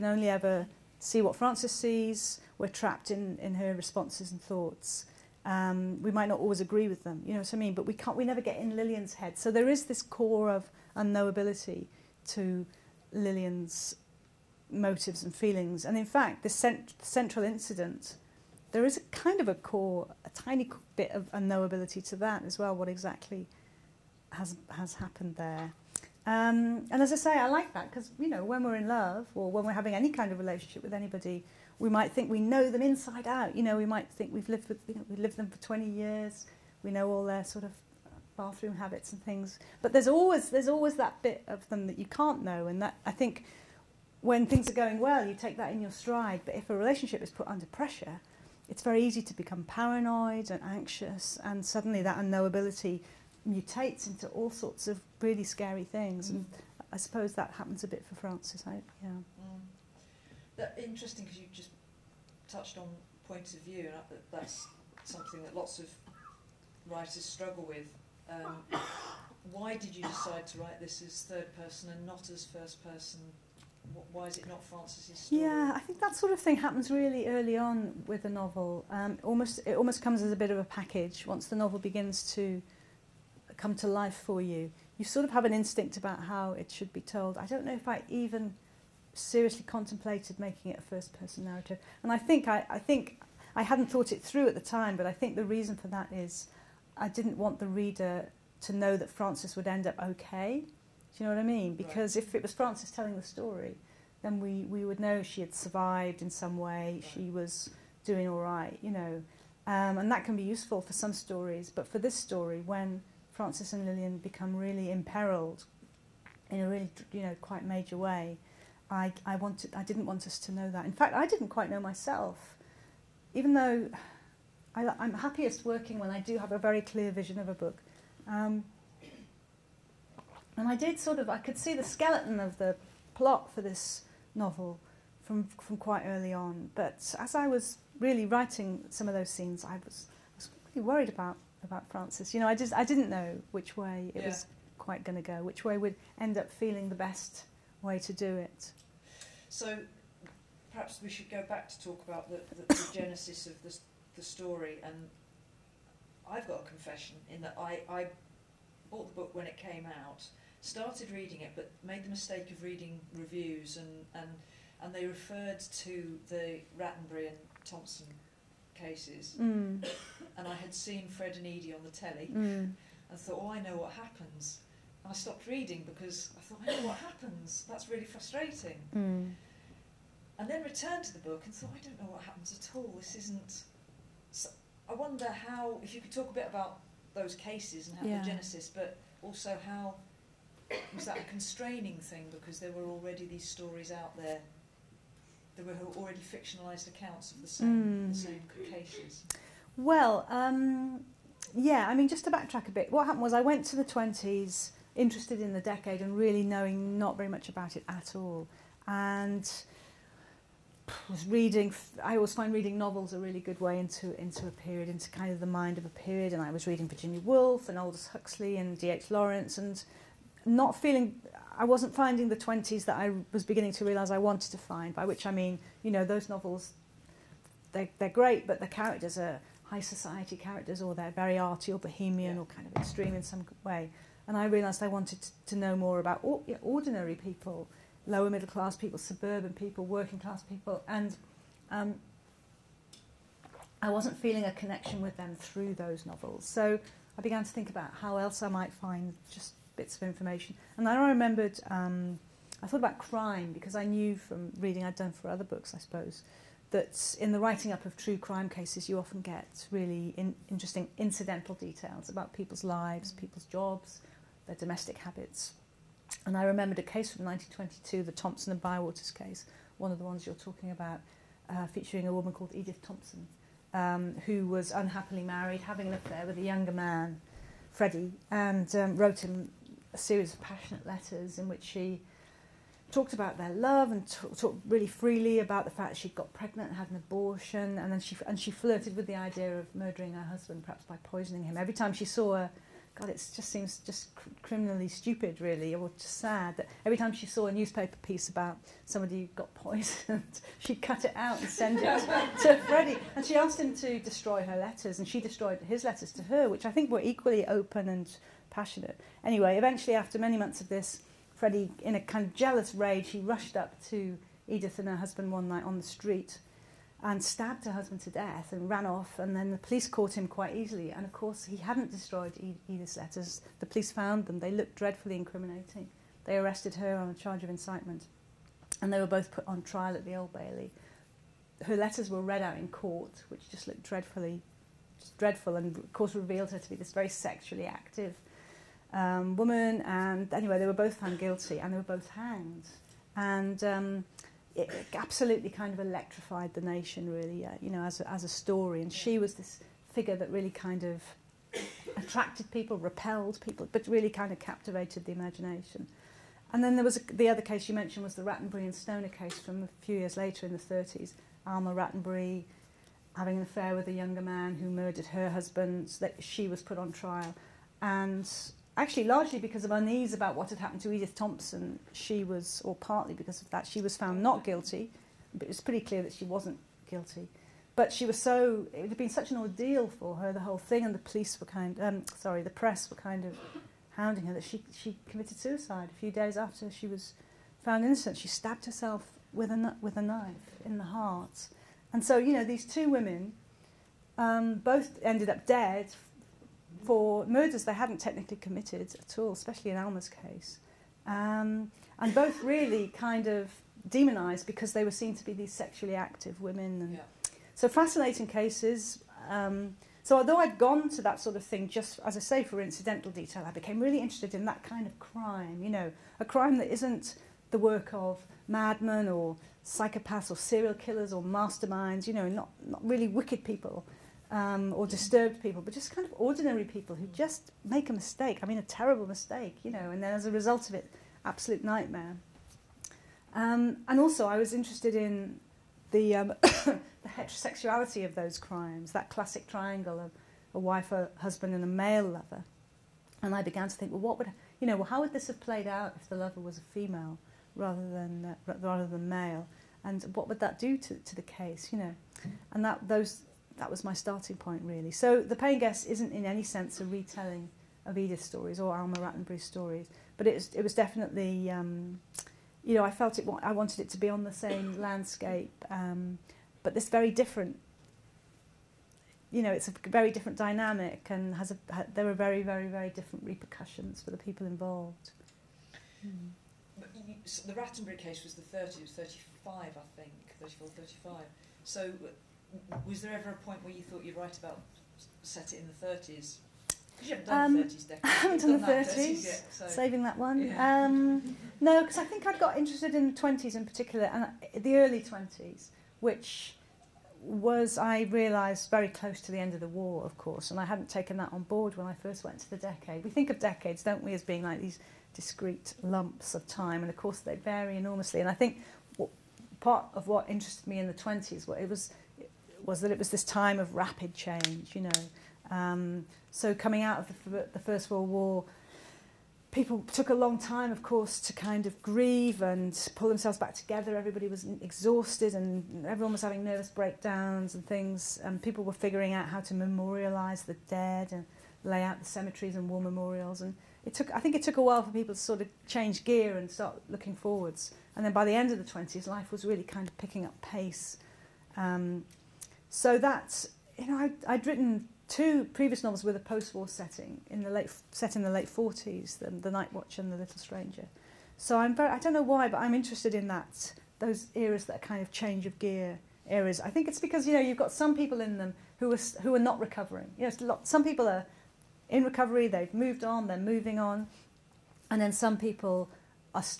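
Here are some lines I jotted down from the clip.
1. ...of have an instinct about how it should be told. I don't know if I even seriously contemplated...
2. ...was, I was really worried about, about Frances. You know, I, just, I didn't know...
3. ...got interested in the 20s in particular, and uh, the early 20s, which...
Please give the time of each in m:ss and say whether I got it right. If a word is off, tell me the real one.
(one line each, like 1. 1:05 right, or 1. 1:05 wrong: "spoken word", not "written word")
1. 1:25 right
2. 2:19 right
3. 8:12 right.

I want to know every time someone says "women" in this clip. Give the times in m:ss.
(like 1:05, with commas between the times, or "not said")
6:32, 6:46.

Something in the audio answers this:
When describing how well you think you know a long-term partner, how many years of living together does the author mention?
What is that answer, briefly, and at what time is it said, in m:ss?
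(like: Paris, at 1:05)
20, at 0:35.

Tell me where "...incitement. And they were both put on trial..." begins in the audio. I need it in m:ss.
5:27.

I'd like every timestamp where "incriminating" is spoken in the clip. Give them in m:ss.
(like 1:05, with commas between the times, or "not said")
5:25.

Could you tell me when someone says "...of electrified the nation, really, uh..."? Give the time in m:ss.
5:45.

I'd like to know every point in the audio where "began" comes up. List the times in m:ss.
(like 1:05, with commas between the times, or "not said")
4:07, 7:23.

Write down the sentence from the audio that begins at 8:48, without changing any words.
And people were figuring out how to memorialise the dead and lay out the cemeteries and war memorials.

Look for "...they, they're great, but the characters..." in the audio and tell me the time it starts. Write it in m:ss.
3:47.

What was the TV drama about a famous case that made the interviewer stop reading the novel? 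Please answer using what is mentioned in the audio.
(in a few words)
Fred and Edie.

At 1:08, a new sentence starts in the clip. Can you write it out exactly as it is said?
Um, why did you decide to write this as third person and not as first person?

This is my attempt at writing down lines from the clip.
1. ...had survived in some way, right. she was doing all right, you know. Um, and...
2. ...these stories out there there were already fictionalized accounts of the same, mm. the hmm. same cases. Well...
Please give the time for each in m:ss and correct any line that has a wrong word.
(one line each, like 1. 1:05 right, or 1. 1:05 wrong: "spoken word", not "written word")
1. 1:45 right
2. 3:13 right.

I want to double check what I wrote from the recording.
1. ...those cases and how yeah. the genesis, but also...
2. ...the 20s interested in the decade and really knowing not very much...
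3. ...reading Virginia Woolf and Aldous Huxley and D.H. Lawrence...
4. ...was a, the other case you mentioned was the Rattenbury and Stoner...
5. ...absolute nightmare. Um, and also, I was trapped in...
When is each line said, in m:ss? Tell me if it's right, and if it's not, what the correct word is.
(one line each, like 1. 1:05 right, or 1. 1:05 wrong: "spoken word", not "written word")
1. 3:07 right
2. 3:23 right
3. 3:36 right
4. 5:56 right
5. 7:11 wrong: "interested", not "trapped".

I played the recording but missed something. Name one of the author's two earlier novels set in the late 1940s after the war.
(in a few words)
The Night Watch.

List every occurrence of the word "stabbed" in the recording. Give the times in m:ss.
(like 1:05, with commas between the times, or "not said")
5:17, 6:28.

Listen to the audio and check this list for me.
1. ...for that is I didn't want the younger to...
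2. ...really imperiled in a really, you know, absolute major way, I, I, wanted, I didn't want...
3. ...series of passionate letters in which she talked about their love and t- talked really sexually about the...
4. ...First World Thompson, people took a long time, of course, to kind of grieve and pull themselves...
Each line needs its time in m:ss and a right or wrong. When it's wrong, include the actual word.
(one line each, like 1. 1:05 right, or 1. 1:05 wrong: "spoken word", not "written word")
1. 1:35 wrong: "reader", not "younger"
2. 1:54 wrong: "quite", not "absolute"
3. 4:39 wrong: "freely", not "sexually"
4. 8:37 wrong: "War", not "Thompson".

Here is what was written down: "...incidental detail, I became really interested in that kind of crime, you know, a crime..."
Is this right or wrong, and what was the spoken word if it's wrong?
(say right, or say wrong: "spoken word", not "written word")
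right.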